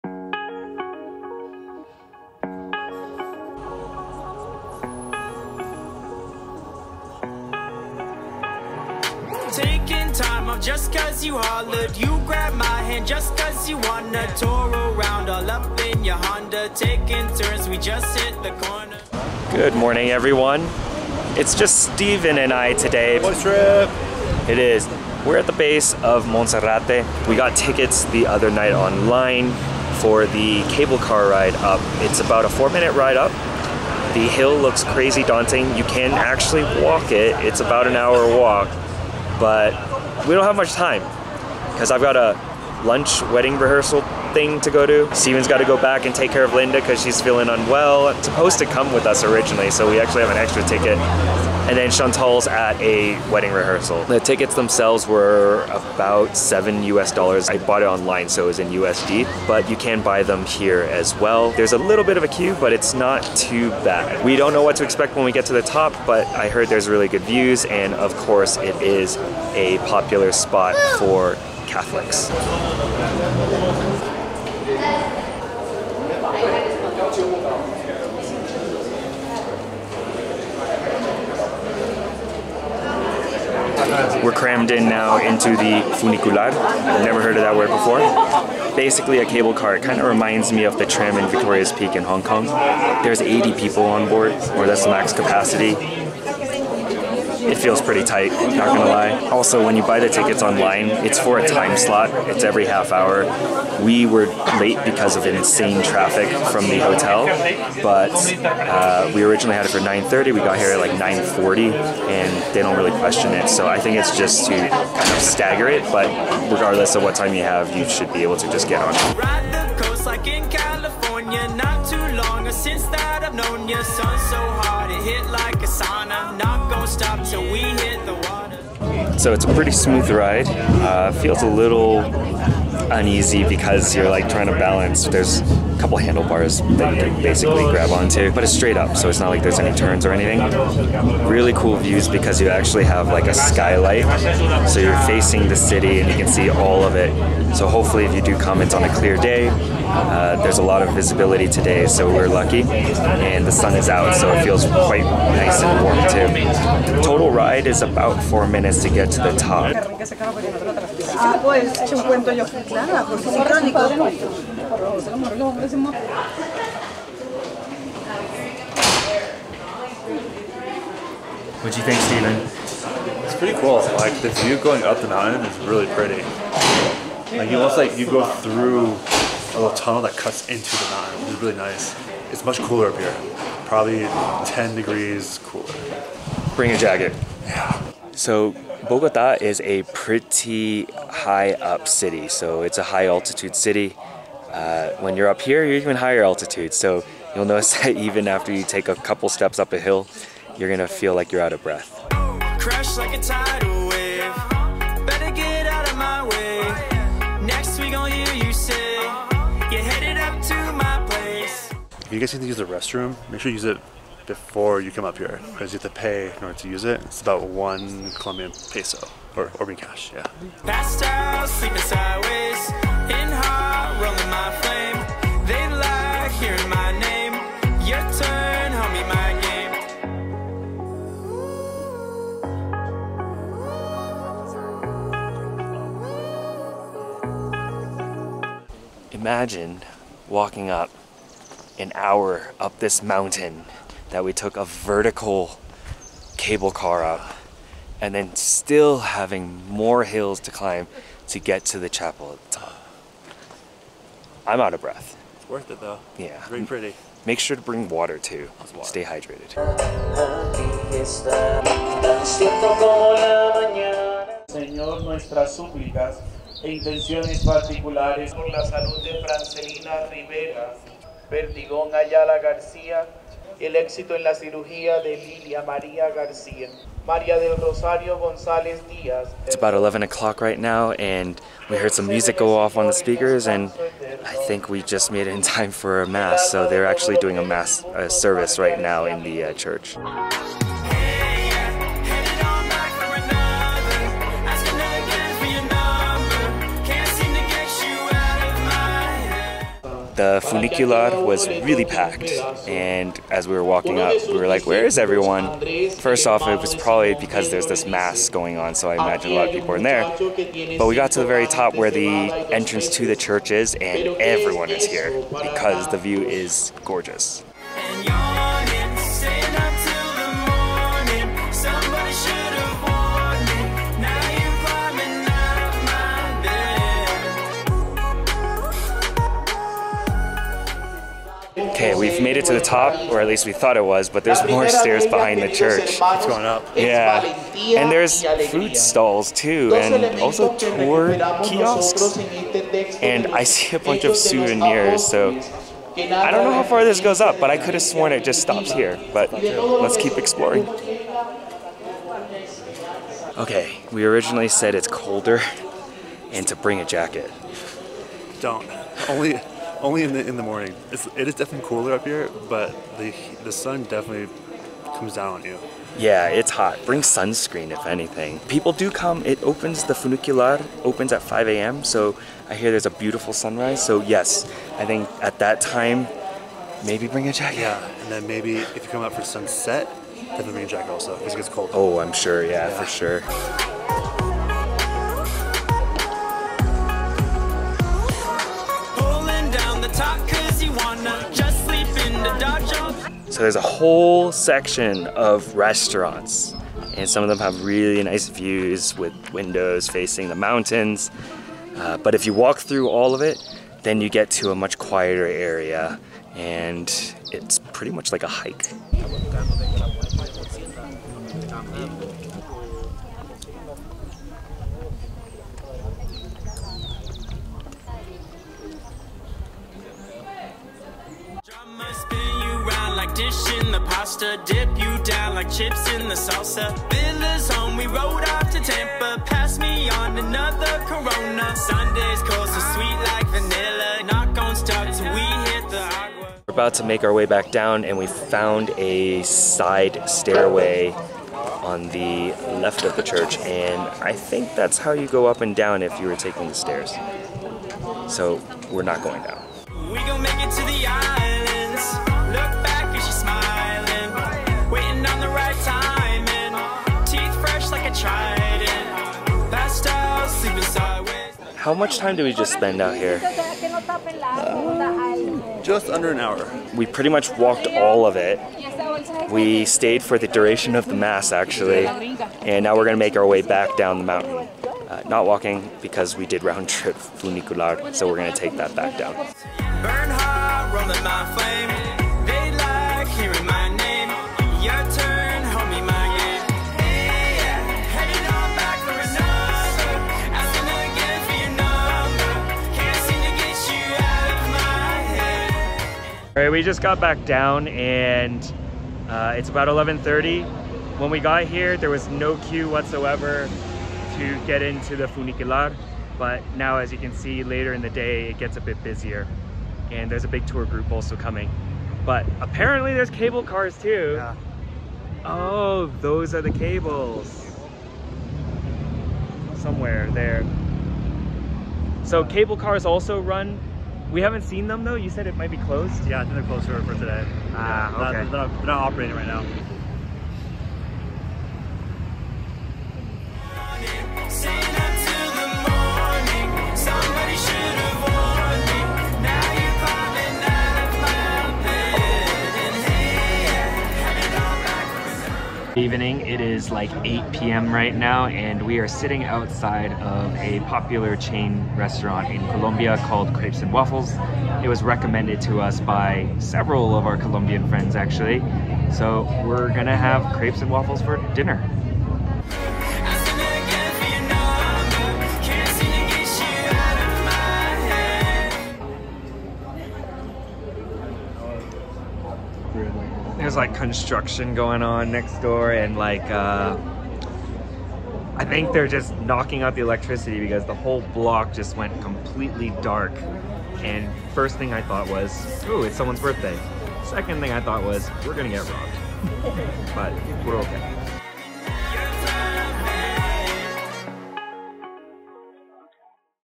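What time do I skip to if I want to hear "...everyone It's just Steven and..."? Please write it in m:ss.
0:20.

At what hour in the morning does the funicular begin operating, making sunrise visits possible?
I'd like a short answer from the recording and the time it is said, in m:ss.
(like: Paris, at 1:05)
5 a.m., at 6:11.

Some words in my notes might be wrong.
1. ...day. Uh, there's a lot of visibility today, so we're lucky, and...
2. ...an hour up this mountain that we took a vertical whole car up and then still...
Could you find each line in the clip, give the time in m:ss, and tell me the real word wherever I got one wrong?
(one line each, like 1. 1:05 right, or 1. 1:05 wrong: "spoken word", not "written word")
1. 2:29 right
2. 4:01 wrong: "cable", not "whole".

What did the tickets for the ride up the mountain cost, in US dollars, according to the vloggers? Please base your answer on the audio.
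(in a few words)
7 US dollars.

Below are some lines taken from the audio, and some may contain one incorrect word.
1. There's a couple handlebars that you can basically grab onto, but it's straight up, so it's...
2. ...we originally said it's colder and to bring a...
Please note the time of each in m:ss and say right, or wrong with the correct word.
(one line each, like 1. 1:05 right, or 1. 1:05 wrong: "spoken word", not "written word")
1. 2:15 right
2. 5:53 right.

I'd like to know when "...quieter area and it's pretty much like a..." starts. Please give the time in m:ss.
6:44.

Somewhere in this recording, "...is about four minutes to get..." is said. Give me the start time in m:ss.
2:37.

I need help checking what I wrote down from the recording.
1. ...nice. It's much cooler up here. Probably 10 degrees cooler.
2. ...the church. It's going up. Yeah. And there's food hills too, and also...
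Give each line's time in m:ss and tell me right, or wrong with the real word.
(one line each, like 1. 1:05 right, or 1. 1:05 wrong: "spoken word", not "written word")
1. 3:01 right
2. 5:35 wrong: "stalls", not "hills".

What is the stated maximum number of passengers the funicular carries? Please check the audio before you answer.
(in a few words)
80.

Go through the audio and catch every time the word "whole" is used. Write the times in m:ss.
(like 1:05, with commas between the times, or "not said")
6:33, 9:40.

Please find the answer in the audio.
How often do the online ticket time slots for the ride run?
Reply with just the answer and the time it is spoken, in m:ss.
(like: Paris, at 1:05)
Every half hour, at 1:42.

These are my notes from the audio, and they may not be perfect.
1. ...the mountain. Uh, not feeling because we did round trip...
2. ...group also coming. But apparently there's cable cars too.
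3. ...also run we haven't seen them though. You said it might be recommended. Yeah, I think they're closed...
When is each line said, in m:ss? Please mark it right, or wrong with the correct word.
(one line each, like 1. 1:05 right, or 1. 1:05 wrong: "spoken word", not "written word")
1. 7:53 wrong: "walking", not "feeling"
2. 8:30 right
3. 8:42 wrong: "closed", not "recommended".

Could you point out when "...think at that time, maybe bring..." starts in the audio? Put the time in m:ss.
6:14.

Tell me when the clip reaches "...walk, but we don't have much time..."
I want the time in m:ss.
0:38.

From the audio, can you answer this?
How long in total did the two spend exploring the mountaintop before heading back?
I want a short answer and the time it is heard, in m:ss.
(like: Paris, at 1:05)
Just under an hour, at 7:45.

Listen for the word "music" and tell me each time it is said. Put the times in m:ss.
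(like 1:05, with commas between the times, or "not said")
4:42.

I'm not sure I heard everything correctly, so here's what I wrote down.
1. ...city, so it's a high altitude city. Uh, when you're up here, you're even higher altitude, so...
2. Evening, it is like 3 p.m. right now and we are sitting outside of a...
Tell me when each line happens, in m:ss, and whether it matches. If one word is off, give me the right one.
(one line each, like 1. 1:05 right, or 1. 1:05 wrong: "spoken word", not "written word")
1. 3:11 right
2. 9:05 wrong: "8", not "3".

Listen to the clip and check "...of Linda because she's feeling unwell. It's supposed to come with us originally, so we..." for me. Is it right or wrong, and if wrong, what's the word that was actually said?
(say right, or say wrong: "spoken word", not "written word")
right.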